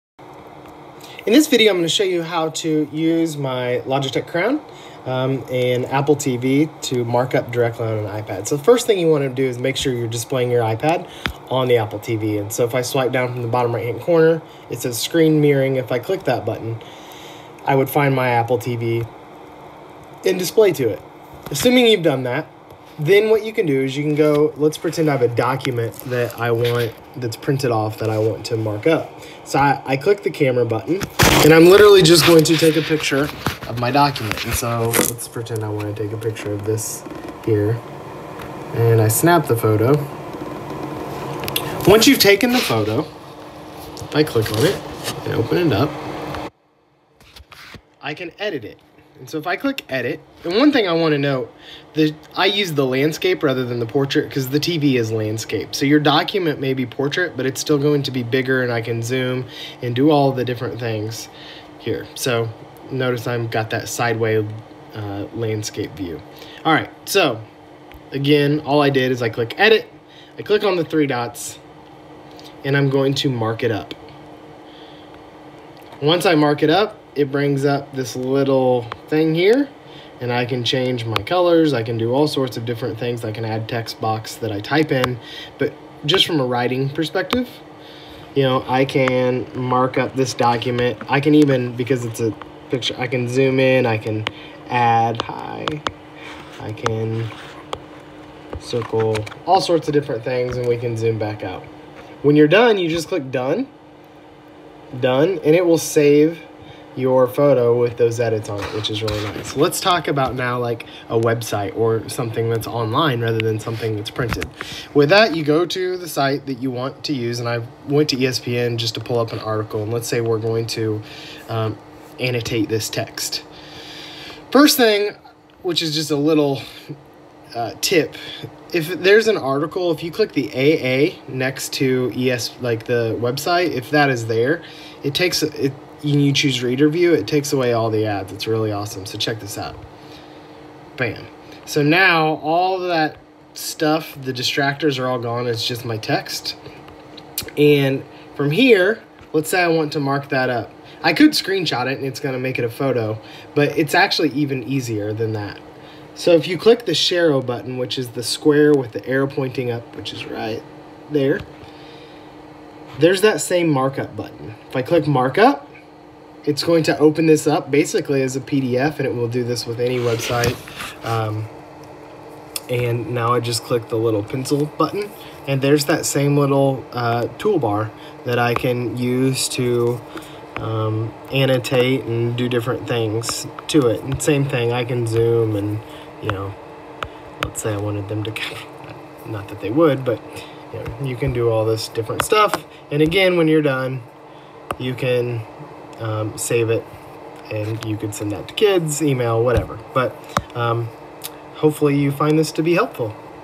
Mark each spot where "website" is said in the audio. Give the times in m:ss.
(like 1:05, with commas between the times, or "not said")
1:51, 2:13, 2:49.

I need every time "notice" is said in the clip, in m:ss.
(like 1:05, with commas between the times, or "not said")
1:02.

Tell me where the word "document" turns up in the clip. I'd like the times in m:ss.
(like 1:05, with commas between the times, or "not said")
0:25, 0:33, 0:55, 1:30.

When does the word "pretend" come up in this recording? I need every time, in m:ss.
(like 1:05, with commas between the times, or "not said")
0:24, 0:35.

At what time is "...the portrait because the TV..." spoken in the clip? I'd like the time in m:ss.
0:53.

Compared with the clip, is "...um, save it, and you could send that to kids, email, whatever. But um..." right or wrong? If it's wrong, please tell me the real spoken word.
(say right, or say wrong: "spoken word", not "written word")
right.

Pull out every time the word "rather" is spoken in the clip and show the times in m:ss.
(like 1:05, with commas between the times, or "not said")
0:53, 1:53.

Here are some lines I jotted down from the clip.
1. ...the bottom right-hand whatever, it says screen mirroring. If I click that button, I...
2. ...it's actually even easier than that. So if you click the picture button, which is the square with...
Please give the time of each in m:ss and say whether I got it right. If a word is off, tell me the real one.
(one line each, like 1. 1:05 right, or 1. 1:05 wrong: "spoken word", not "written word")
1. 0:13 wrong: "corner", not "whatever"
2. 2:33 wrong: "share", not "picture".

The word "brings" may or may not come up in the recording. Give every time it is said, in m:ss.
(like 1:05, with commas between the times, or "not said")
1:17.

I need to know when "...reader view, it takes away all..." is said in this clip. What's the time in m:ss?
2:16.